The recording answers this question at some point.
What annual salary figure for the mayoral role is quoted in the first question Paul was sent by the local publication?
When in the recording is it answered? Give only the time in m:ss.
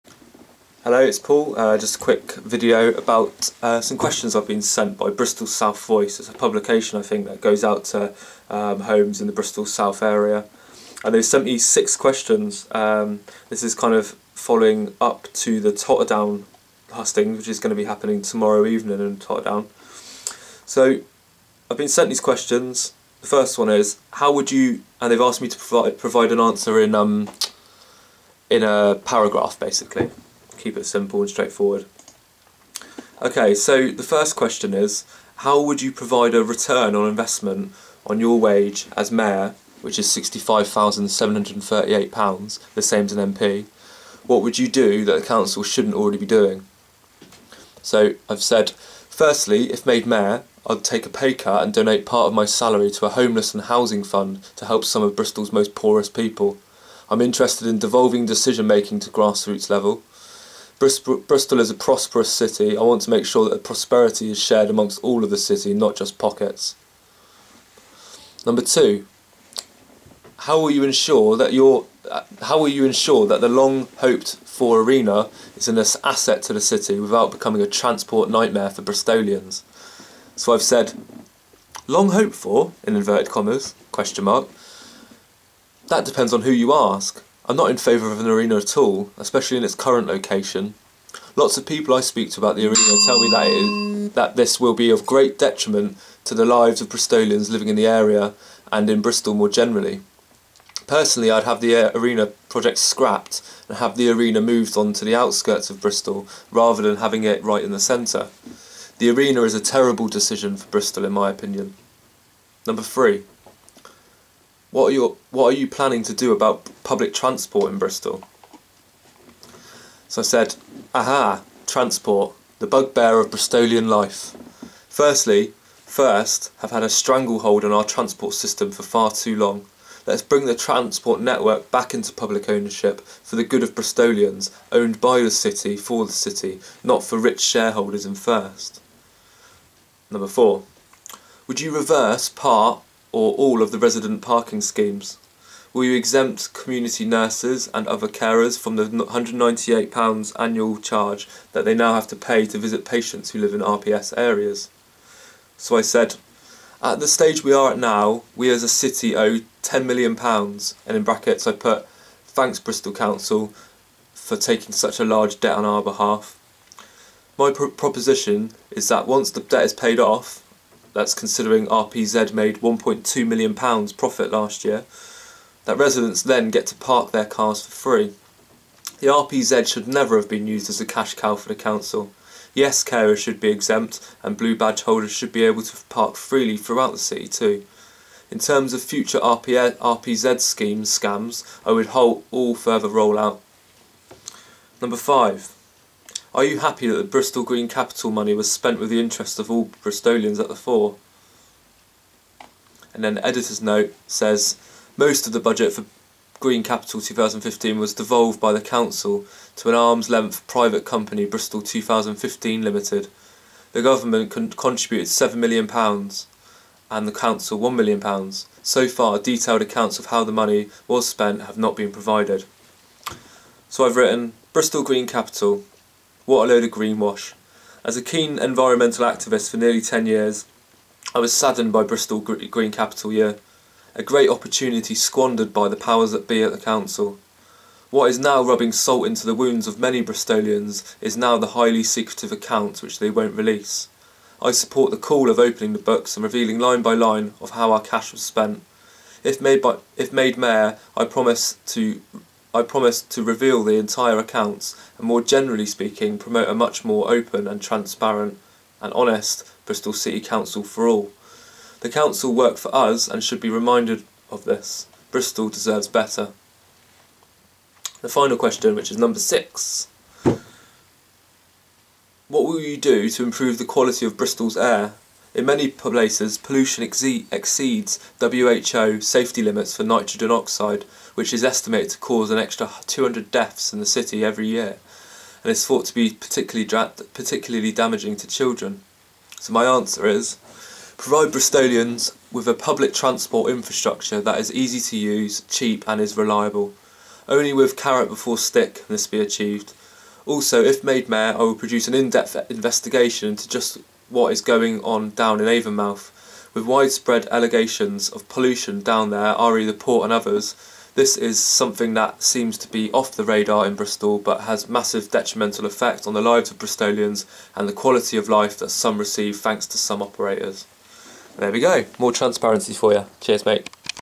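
0:40.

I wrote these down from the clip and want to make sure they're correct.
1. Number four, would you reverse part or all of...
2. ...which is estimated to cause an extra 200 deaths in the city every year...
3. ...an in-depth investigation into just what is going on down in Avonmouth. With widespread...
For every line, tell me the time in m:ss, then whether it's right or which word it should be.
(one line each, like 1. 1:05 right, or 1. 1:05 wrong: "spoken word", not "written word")
1. 2:20 right
2. 4:41 right
3. 5:01 right.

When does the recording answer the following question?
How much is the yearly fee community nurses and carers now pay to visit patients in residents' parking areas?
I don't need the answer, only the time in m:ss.
2:28.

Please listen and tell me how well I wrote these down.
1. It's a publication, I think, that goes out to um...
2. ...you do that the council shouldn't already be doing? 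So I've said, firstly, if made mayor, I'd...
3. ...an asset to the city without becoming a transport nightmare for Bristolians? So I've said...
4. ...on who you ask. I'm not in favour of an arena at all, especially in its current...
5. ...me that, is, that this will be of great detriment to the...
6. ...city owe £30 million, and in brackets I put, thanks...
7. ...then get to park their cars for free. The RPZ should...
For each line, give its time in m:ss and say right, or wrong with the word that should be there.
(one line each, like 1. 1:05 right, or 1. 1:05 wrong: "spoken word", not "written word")
1. 0:06 right
2. 0:44 right
3. 1:15 right
4. 1:26 right
5. 1:33 right
6. 2:38 wrong: "10", not "30"
7. 2:56 right.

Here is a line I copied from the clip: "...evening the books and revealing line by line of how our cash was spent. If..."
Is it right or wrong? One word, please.
wrong.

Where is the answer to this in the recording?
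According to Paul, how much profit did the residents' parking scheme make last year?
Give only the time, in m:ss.
2:52.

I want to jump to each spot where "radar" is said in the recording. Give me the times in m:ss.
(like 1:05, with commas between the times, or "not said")
5:13.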